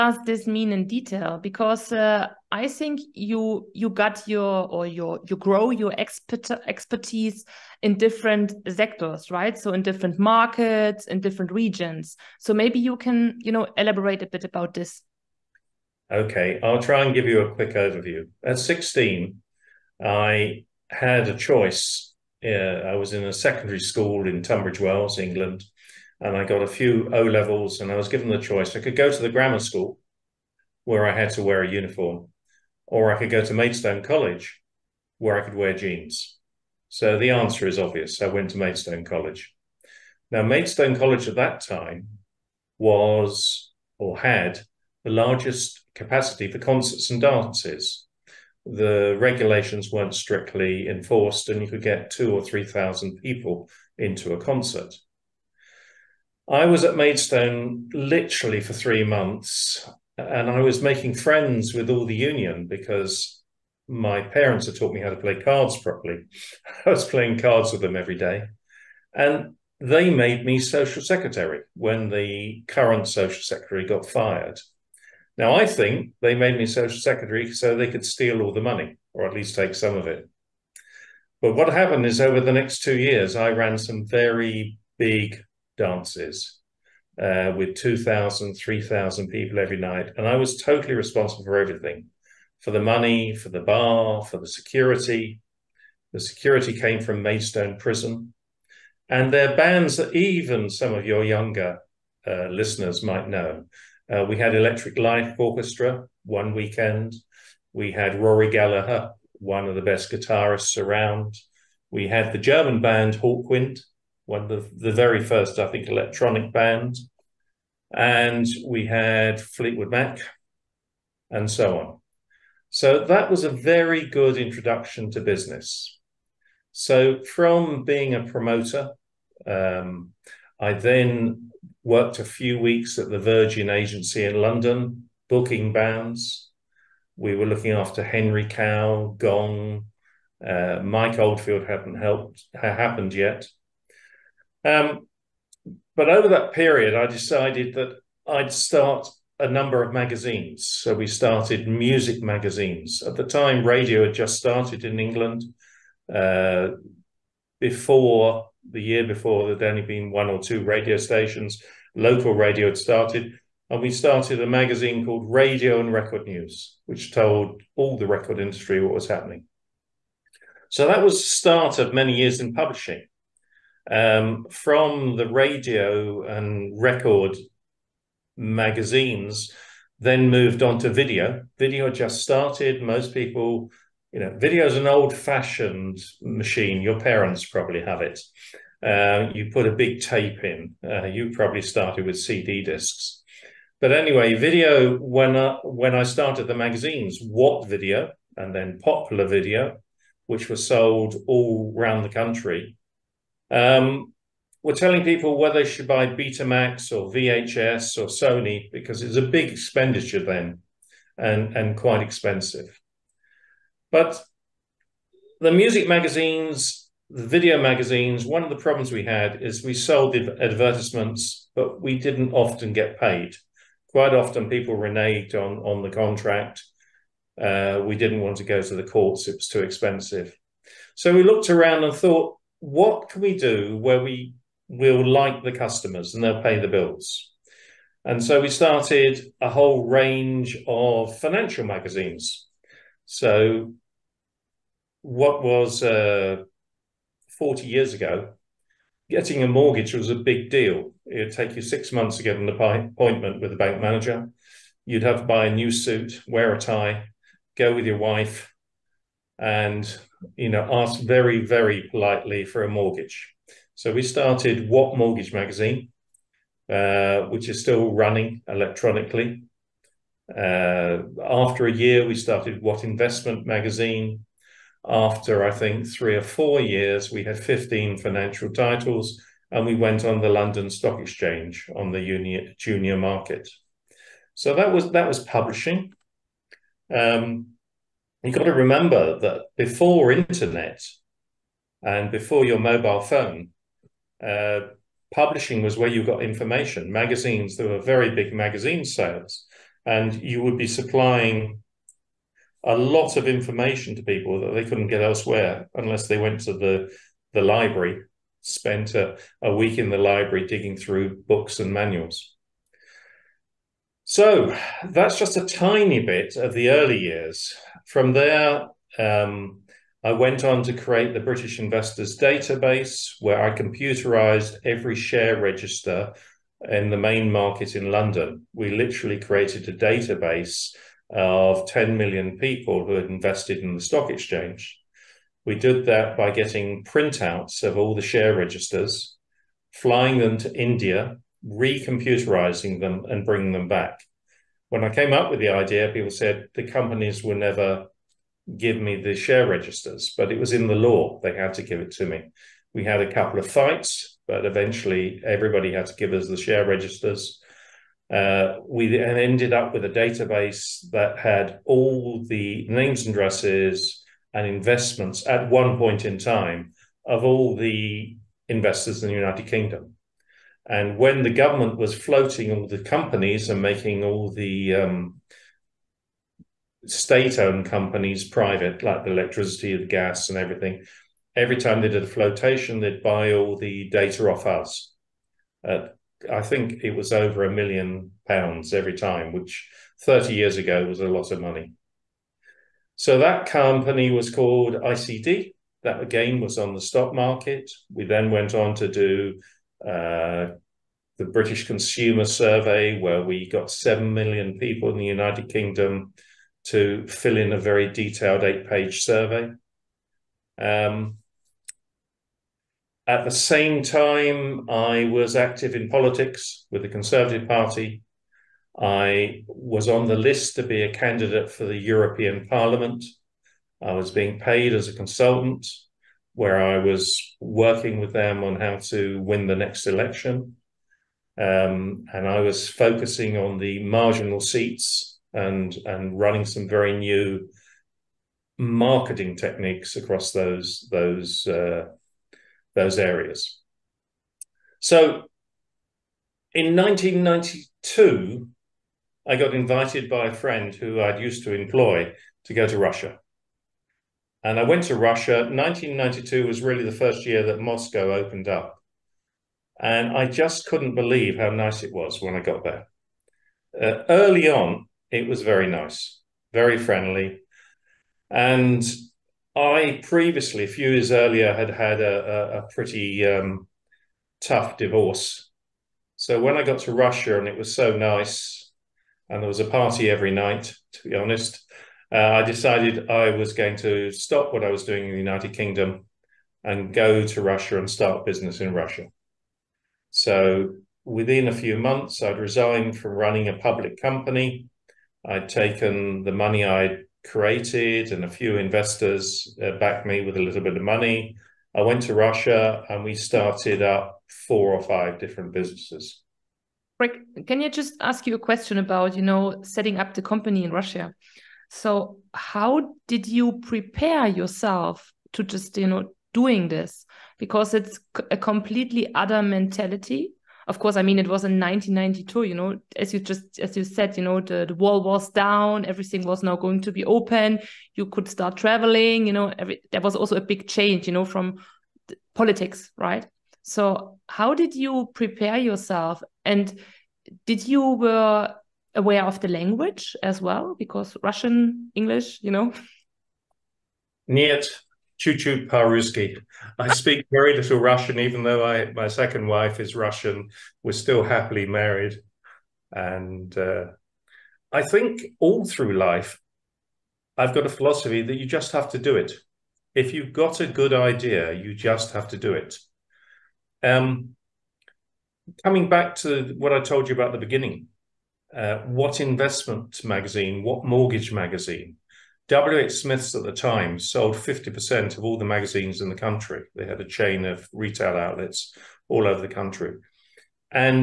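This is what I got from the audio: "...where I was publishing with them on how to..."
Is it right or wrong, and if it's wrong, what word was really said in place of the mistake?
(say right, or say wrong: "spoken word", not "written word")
wrong: "working", not "publishing".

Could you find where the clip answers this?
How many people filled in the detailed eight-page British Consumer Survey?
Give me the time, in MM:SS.
06:43.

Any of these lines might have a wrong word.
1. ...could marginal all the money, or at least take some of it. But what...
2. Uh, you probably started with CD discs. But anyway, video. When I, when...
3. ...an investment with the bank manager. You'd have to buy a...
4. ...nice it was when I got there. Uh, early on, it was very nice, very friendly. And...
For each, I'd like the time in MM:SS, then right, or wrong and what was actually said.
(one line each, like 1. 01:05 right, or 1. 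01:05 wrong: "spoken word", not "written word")
1. 01:17 wrong: "steal", not "marginal"
2. 03:10 right
3. 04:12 wrong: "appointment", not "investment"
4. 07:41 right.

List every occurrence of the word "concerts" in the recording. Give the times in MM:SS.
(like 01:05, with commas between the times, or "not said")
00:46, 00:54.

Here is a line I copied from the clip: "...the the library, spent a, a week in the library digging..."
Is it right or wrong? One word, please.
right.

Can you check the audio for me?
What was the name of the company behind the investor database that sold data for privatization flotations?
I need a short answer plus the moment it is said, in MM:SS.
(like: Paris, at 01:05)
ICD, at 06:34.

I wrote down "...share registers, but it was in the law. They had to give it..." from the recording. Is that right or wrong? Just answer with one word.
right.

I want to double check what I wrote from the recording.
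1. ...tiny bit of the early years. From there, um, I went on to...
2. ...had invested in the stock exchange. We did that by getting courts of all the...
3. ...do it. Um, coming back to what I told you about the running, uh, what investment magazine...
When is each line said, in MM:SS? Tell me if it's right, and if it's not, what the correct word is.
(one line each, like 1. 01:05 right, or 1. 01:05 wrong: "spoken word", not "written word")
1. 05:15 right
2. 05:32 wrong: "printouts", not "courts"
3. 09:22 wrong: "beginning", not "running".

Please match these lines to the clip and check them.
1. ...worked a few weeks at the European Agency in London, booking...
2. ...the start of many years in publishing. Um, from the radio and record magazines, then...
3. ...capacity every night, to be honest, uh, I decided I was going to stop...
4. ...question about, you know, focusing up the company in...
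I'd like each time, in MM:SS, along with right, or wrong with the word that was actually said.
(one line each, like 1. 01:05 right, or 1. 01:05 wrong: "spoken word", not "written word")
1. 02:11 wrong: "Virgin", not "European"
2. 02:51 right
3. 07:59 wrong: "party", not "capacity"
4. 08:28 wrong: "setting", not "focusing".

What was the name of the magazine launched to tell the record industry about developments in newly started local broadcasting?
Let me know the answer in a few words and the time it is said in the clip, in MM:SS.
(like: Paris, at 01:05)
Radio and Record News, at 02:45.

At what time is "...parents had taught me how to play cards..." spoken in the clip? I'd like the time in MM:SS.
01:04.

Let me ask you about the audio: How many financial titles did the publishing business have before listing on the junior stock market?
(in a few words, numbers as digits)
15.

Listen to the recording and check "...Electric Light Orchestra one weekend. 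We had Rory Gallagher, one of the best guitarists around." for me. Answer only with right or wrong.
right.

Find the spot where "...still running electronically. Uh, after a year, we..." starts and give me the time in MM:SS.
04:27.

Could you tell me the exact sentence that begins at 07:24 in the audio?
So in 1992, I got invited by a friend who I'd used to employ to go to Russia.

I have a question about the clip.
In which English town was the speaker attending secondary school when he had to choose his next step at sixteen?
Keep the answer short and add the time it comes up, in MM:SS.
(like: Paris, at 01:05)
Tunbridge Wells, at 00:24.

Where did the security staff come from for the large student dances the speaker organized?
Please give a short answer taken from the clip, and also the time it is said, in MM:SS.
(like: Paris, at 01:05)
Maidstone Prison, at 01:37.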